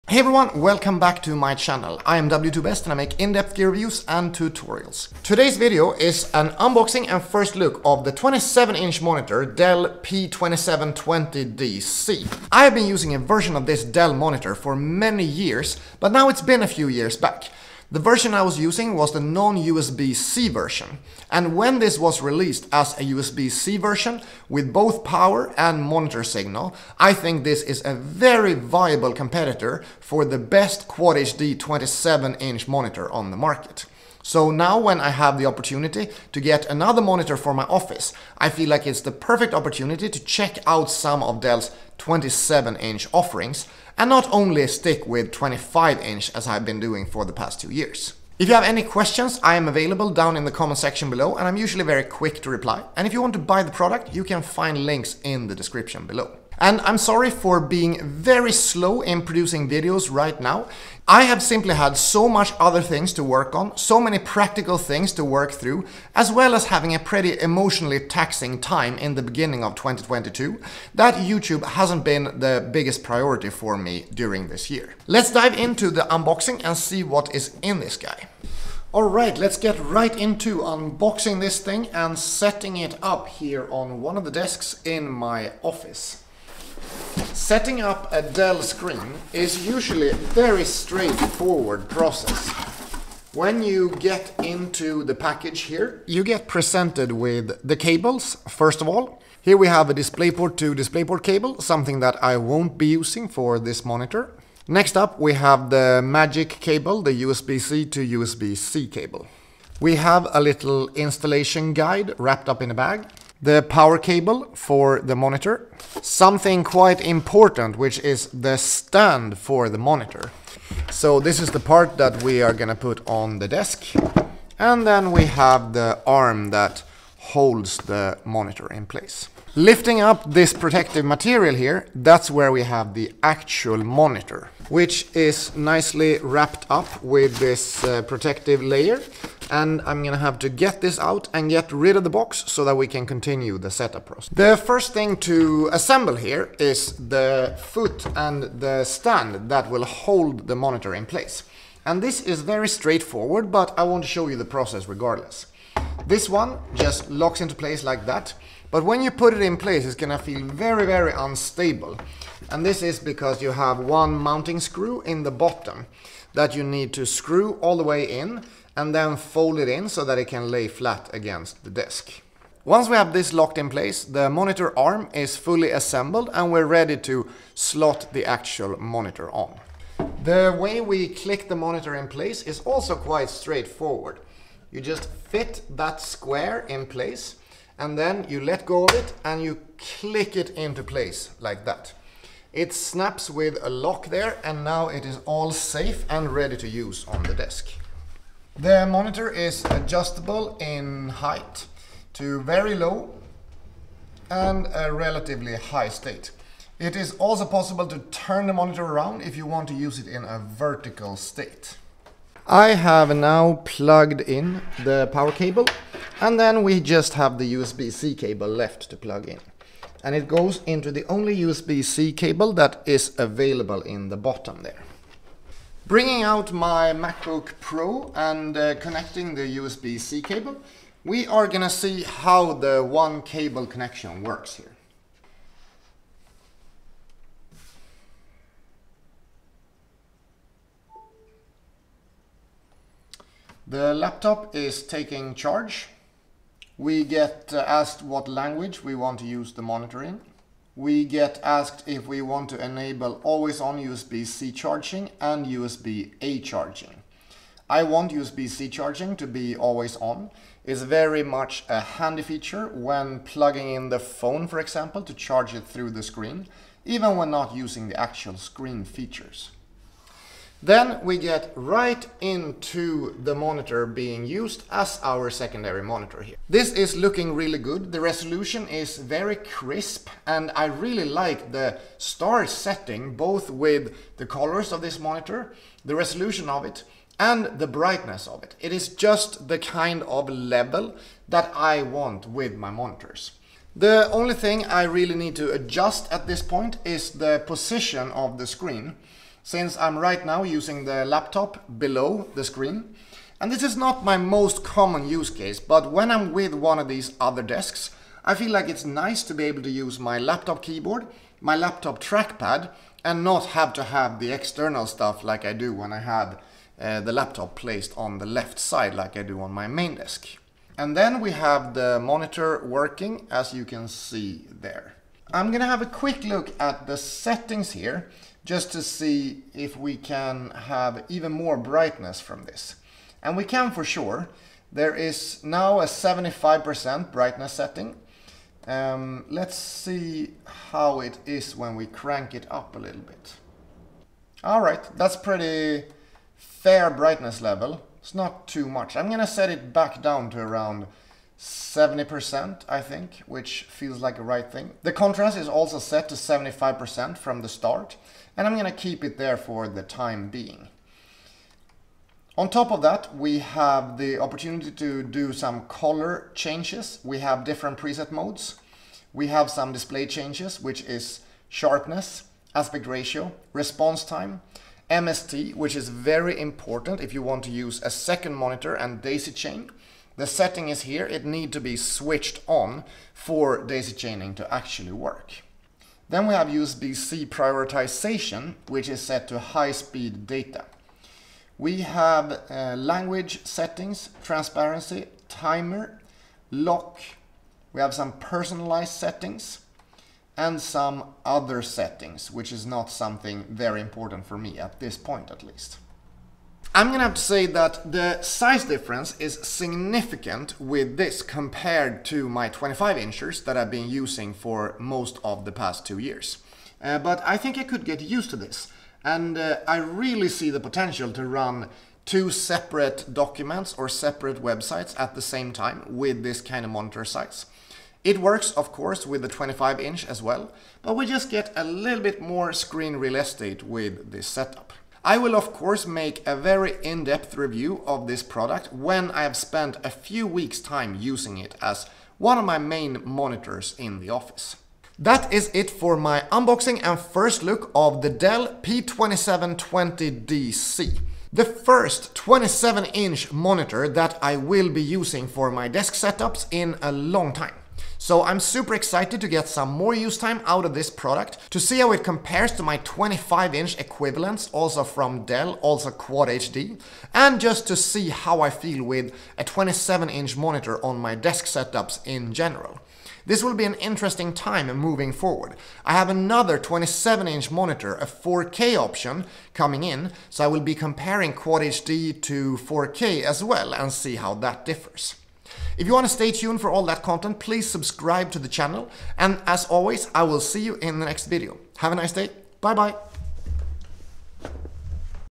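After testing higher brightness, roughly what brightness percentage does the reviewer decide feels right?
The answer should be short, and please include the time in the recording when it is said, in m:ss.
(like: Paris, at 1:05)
70%, at 5:51.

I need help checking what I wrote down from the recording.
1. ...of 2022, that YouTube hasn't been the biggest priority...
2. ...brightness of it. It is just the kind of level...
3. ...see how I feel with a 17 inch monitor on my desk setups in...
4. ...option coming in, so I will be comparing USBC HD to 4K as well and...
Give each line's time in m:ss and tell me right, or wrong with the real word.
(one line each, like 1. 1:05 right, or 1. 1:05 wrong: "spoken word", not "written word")
1. 1:09 right
2. 4:47 right
3. 7:47 wrong: "27", not "17"
4. 7:58 wrong: "Quad", not "USBC".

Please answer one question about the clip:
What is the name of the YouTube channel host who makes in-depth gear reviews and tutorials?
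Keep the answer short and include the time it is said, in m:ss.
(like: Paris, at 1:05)
W2Best, at 0:02.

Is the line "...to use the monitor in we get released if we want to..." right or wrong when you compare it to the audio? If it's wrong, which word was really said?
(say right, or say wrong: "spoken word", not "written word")
wrong: "asked", not "released".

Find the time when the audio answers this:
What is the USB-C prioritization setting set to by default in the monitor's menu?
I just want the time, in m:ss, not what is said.
6:29.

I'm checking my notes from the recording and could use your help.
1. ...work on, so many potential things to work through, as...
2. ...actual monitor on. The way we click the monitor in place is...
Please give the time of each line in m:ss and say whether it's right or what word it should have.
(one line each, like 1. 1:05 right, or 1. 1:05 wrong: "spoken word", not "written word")
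1. 1:03 wrong: "practical", not "potential"
2. 2:58 right.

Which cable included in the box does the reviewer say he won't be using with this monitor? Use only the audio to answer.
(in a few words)
DisplayPort to DisplayPort.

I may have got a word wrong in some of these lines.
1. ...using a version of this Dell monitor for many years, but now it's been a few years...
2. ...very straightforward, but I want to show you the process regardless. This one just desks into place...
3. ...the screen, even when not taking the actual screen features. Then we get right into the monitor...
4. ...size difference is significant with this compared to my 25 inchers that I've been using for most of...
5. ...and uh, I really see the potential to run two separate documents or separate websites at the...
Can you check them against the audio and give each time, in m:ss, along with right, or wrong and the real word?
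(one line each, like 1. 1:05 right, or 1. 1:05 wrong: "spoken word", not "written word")
1. 0:12 right
2. 2:32 wrong: "locks", not "desks"
3. 4:25 wrong: "using", not "taking"
4. 6:48 right
5. 6:59 right.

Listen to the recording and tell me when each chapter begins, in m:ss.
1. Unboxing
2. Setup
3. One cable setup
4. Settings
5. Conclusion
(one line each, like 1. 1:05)
1. 1:15
2. 2:25
3. 3:50
4. 5:25
5. 7:25.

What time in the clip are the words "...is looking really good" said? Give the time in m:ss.
4:36.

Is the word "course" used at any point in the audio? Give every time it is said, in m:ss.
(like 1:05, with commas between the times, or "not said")
7:08, 7:15.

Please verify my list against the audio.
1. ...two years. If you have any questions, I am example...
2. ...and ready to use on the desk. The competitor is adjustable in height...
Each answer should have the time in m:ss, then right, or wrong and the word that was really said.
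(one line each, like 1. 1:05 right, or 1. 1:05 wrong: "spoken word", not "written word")
1. 0:47 wrong: "available", not "example"
2. 3:16 wrong: "monitor", not "competitor".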